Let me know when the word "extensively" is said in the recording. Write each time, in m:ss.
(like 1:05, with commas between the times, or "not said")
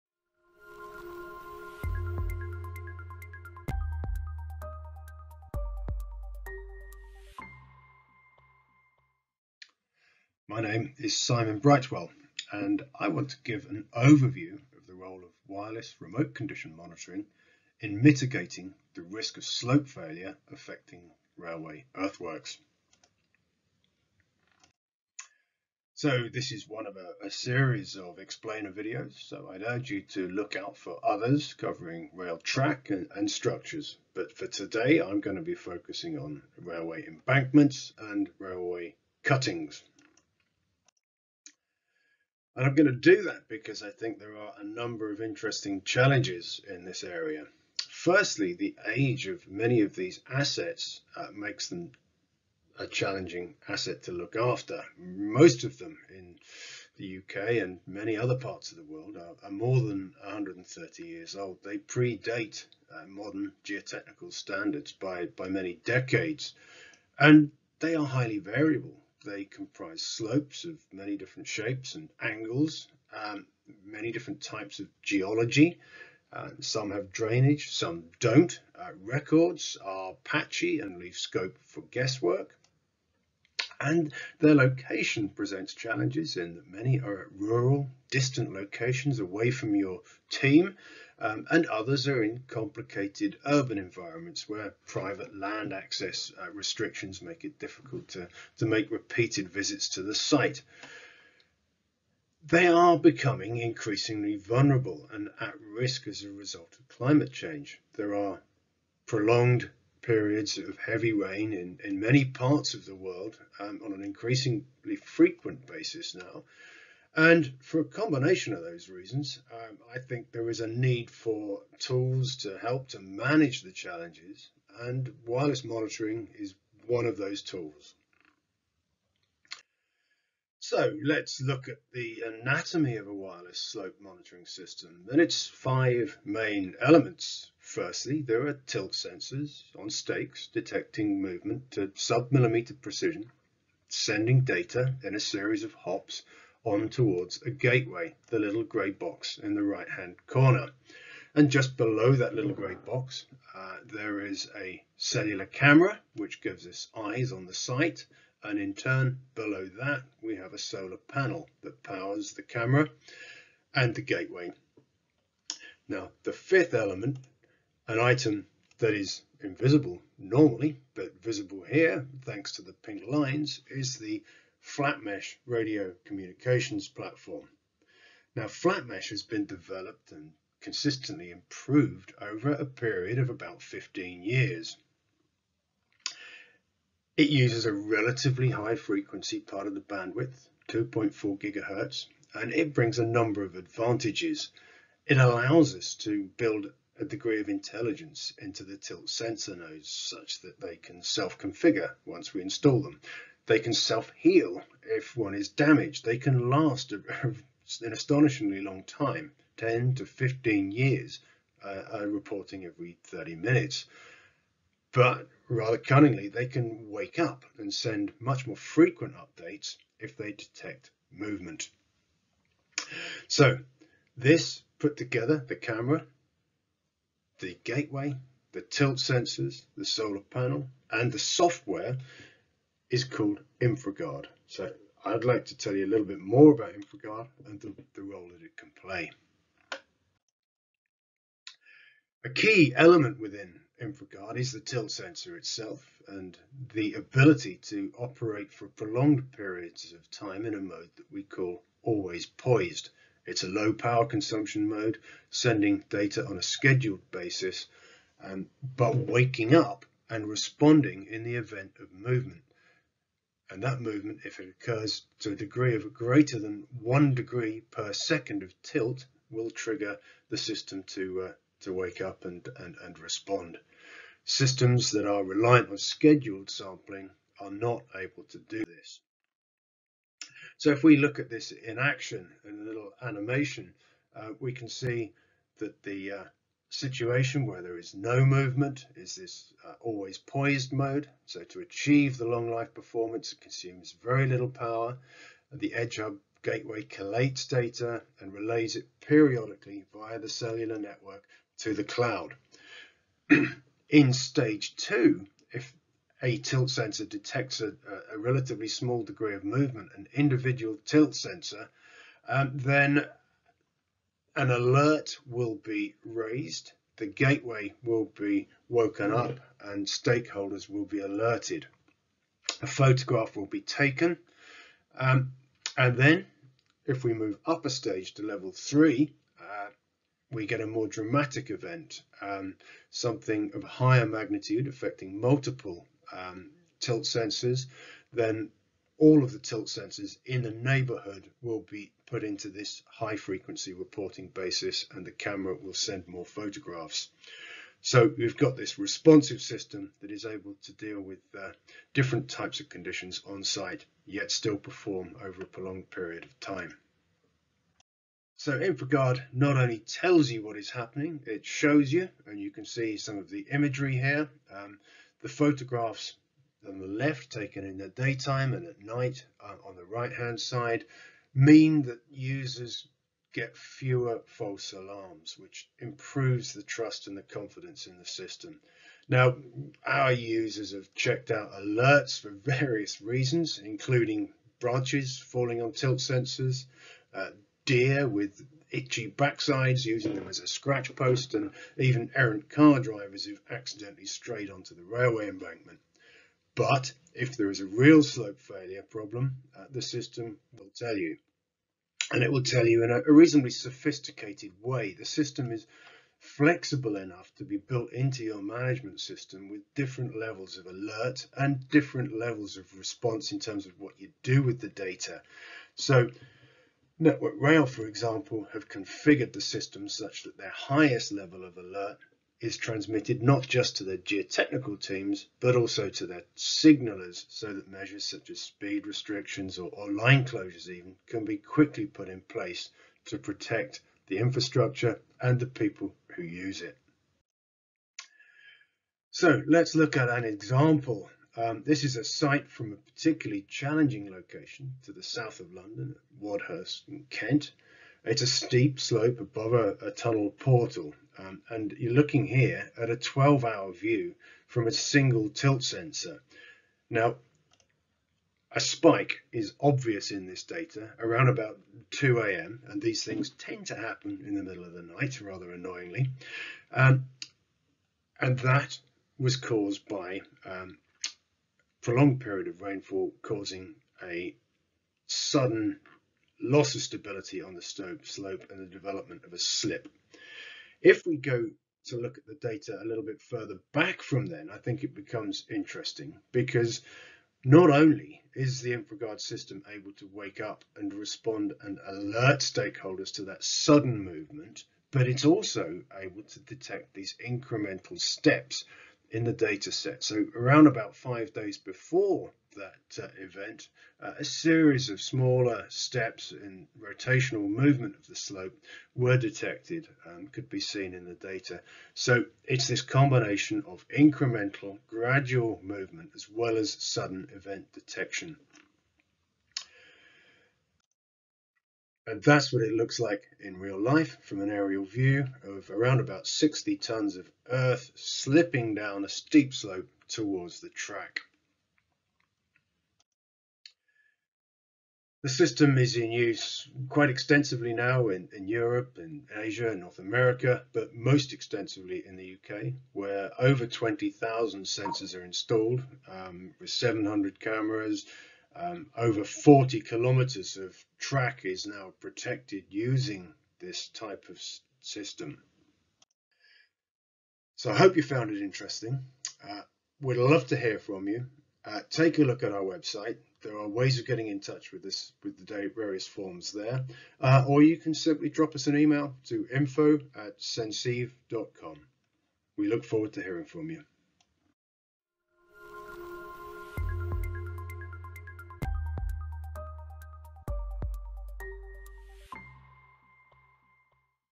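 8:57, 9:01.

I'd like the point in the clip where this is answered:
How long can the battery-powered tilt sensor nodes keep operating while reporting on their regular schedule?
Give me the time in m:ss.
3:29.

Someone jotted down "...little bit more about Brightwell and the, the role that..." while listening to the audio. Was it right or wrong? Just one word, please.
wrong.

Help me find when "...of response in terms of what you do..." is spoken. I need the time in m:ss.
6:52.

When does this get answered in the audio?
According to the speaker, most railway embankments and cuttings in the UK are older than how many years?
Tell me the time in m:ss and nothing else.
1:00.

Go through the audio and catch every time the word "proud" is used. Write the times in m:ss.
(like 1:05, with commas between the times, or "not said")
not said.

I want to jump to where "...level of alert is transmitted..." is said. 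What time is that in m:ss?
7:01.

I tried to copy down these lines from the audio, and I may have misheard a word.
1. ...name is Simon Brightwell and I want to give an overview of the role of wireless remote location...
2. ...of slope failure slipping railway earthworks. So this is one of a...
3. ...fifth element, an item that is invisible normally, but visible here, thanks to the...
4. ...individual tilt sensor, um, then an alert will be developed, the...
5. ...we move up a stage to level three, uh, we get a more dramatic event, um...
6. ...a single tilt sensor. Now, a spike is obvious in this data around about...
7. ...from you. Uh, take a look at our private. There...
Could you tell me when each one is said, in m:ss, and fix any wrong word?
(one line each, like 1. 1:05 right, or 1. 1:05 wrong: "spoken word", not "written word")
1. 0:10 wrong: "condition", not "location"
2. 0:19 wrong: "affecting", not "slipping"
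3. 2:46 right
4. 5:10 wrong: "raised", not "developed"
5. 5:27 right
6. 7:34 right
7. 9:20 wrong: "website", not "private".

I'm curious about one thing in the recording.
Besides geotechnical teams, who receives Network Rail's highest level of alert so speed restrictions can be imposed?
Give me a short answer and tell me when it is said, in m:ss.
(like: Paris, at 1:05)
Signalers, at 7:06.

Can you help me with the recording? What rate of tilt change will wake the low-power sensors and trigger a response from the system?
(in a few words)
1 degree per second.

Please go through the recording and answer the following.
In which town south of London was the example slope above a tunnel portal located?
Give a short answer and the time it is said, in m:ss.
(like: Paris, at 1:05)
Wadhurst, at 7:26.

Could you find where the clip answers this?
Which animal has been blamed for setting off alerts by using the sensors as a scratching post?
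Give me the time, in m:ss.
6:27.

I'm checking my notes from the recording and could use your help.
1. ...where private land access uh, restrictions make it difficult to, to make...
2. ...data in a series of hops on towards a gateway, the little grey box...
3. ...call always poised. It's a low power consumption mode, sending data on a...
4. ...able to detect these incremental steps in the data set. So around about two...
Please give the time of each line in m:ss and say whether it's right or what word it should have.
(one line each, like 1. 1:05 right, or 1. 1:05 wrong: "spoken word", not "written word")
1. 1:34 right
2. 2:24 right
3. 4:11 right
4. 8:15 wrong: "five", not "two".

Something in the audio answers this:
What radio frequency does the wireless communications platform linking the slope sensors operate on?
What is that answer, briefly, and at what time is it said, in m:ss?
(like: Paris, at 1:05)
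2.4 gigahertz, at 3:10.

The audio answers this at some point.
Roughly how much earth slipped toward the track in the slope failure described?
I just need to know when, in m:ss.
8:46.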